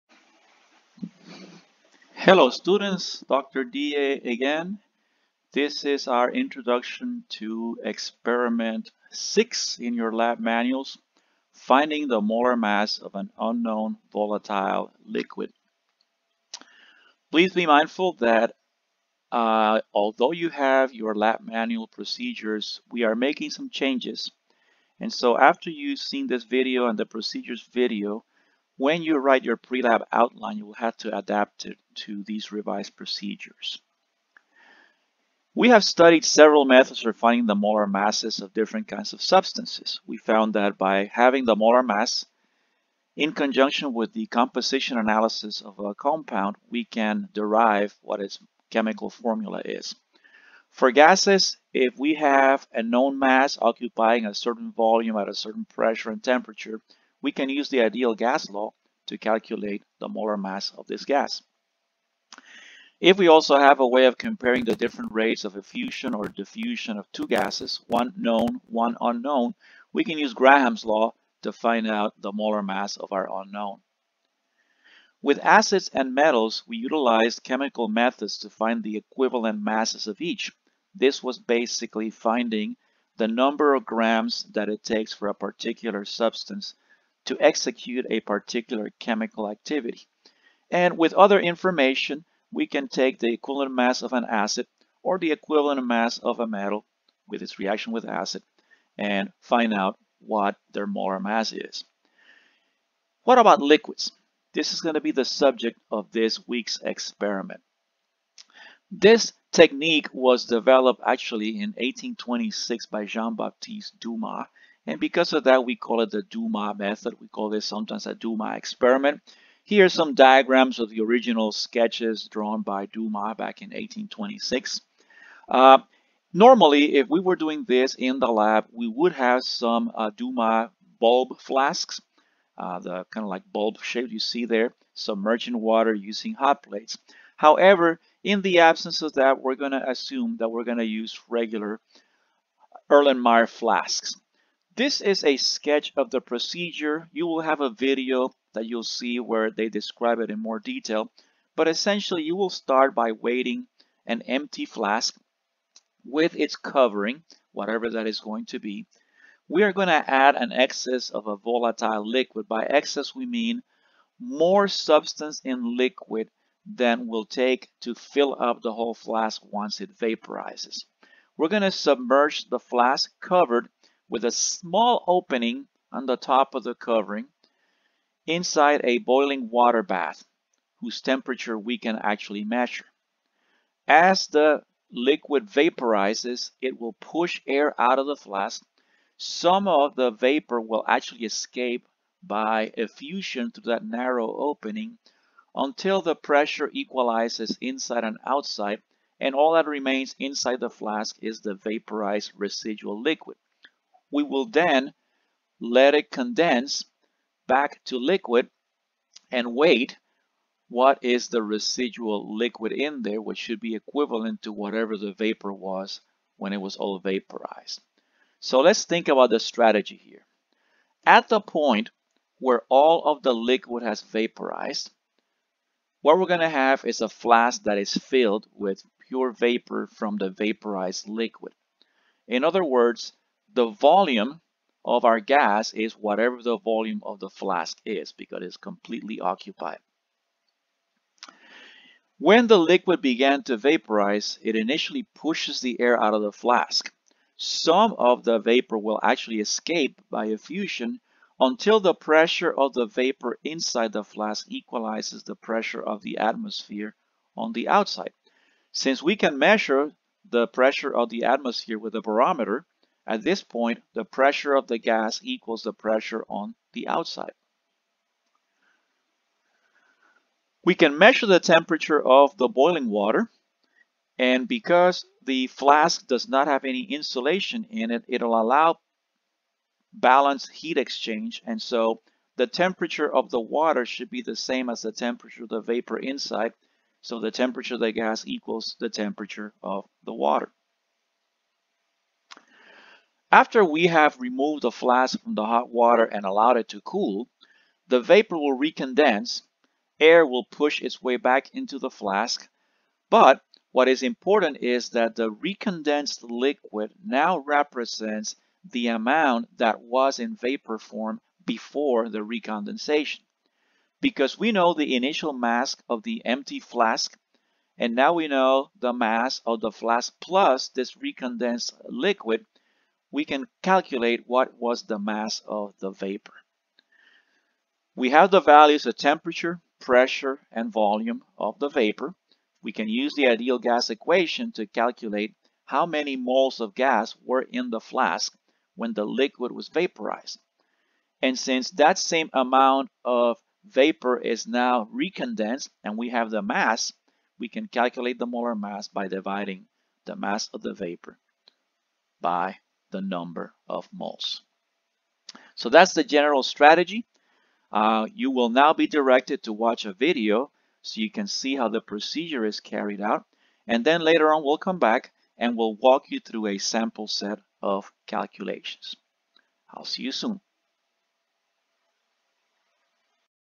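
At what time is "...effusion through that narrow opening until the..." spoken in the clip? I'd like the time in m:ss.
3:12.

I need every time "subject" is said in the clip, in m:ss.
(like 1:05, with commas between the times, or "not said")
1:45.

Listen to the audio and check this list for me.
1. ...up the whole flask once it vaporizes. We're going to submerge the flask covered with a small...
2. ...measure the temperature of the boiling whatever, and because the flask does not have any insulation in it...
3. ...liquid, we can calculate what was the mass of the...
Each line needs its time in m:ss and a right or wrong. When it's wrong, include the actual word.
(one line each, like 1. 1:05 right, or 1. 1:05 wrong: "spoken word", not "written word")
1. 2:48 right
2. 4:30 wrong: "water", not "whatever"
3. 5:21 right.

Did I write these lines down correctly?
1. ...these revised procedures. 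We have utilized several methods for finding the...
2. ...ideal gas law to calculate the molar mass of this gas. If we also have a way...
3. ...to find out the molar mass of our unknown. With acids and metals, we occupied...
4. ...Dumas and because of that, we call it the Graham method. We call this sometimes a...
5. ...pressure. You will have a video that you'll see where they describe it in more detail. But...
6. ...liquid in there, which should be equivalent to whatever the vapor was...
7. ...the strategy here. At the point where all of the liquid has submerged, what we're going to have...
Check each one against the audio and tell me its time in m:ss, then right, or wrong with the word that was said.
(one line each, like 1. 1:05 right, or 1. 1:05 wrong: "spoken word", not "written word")
1. 0:32 wrong: "studied", not "utilized"
2. 0:57 right
3. 1:11 wrong: "utilized", not "occupied"
4. 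1:53 wrong: "Dumas", not "Graham"
5. 2:26 wrong: "procedure", not "pressure"
6. 3:32 right
7. 3:39 wrong: "vaporized", not "submerged".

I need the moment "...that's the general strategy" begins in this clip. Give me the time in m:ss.
5:55.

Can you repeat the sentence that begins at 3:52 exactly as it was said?
In other words, the volume of our gas is whatever the volume of the flask is because it's completely occupied.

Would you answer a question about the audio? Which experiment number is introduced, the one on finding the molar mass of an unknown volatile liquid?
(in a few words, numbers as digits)
6.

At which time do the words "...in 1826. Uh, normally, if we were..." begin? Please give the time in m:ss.
2:03.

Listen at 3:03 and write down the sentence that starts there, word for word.
As the liquid vaporizes, it will push air out of the flask.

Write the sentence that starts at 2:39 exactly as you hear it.
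We are going to add an excess of a volatile liquid.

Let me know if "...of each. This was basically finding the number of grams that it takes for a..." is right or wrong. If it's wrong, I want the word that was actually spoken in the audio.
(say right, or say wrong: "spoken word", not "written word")
right.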